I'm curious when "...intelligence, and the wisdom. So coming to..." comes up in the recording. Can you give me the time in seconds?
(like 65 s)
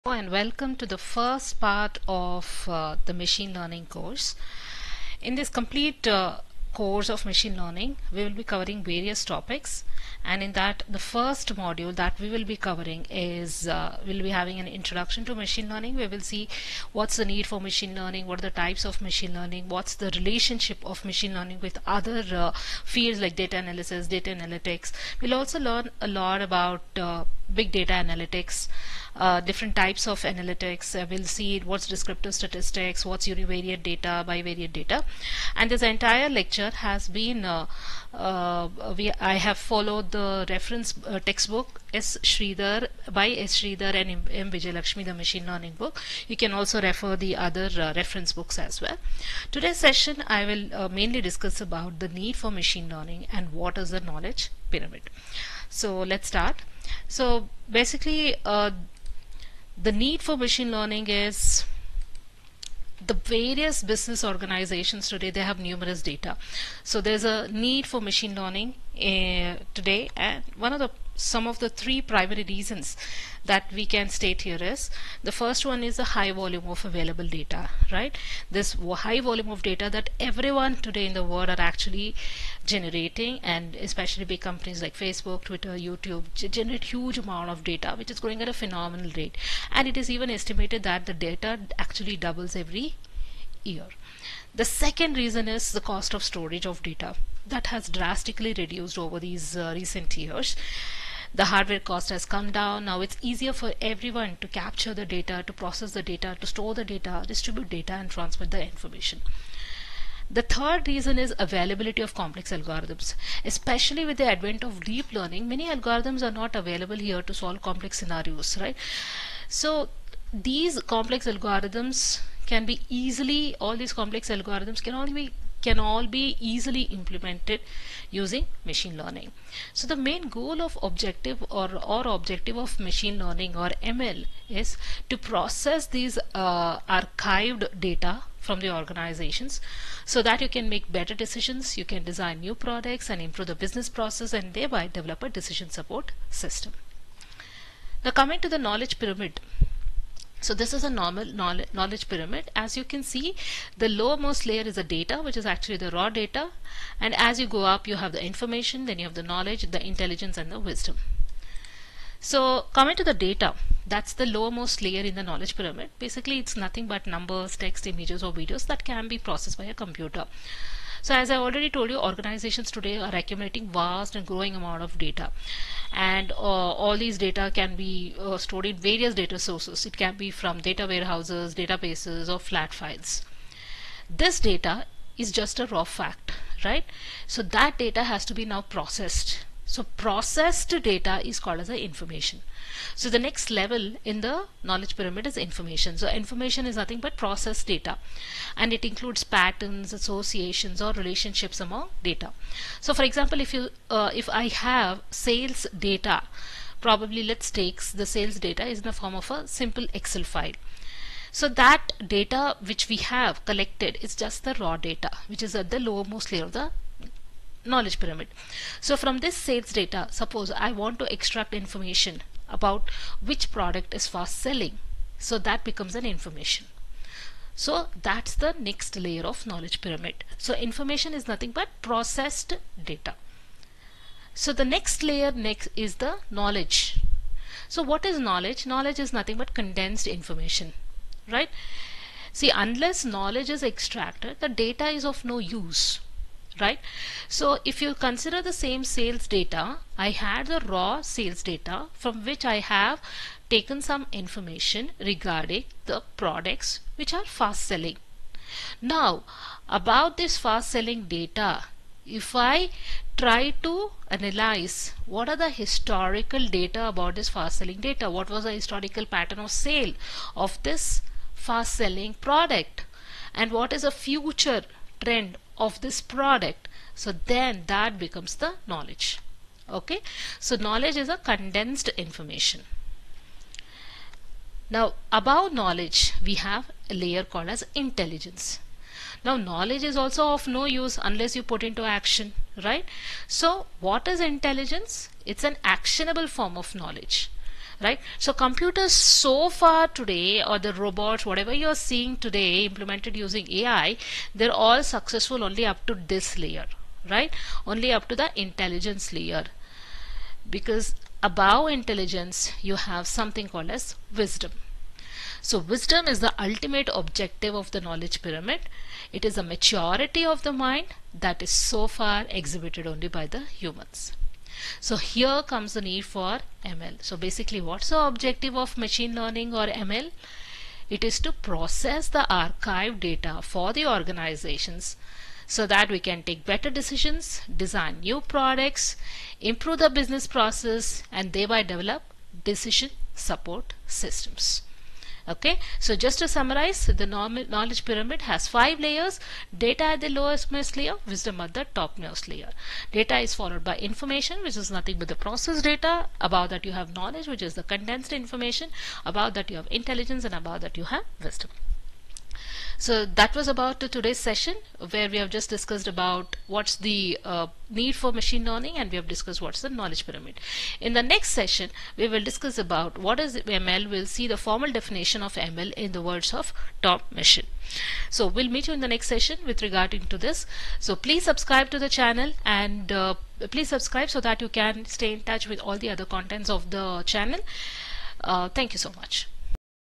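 159 s.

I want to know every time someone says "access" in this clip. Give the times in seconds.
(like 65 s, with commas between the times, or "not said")
not said.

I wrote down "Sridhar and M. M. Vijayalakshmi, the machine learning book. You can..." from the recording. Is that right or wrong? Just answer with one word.
right.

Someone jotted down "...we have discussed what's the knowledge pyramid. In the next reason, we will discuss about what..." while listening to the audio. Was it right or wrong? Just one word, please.
wrong.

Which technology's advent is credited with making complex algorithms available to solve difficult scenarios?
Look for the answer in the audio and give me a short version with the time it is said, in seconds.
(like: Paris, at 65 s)
Deep learning, at 114 s.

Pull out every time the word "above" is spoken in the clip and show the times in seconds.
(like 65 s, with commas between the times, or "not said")
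285 s, 311 s.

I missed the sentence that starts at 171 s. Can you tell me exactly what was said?
So as I already told you, organizations today are accumulating vast and growing amount of data.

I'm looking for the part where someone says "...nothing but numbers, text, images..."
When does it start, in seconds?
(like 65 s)
166 s.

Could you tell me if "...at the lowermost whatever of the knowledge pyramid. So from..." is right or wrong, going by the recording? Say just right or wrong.
wrong.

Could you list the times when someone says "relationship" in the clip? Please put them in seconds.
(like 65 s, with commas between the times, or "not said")
20 s, 200 s.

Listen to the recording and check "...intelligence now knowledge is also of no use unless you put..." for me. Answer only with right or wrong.
right.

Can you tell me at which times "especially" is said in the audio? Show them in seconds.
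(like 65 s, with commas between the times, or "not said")
83 s, 113 s.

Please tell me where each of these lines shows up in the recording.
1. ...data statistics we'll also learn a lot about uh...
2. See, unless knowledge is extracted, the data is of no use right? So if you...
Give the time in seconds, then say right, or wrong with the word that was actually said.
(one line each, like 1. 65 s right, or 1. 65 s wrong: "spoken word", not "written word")
1. 24 s wrong: "analytics", not "statistics"
2. 242 s right.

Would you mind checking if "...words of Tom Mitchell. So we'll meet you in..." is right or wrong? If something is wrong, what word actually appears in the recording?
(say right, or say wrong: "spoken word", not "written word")
right.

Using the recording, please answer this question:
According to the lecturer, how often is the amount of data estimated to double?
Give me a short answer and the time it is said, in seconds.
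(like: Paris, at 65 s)
Every year, at 92 s.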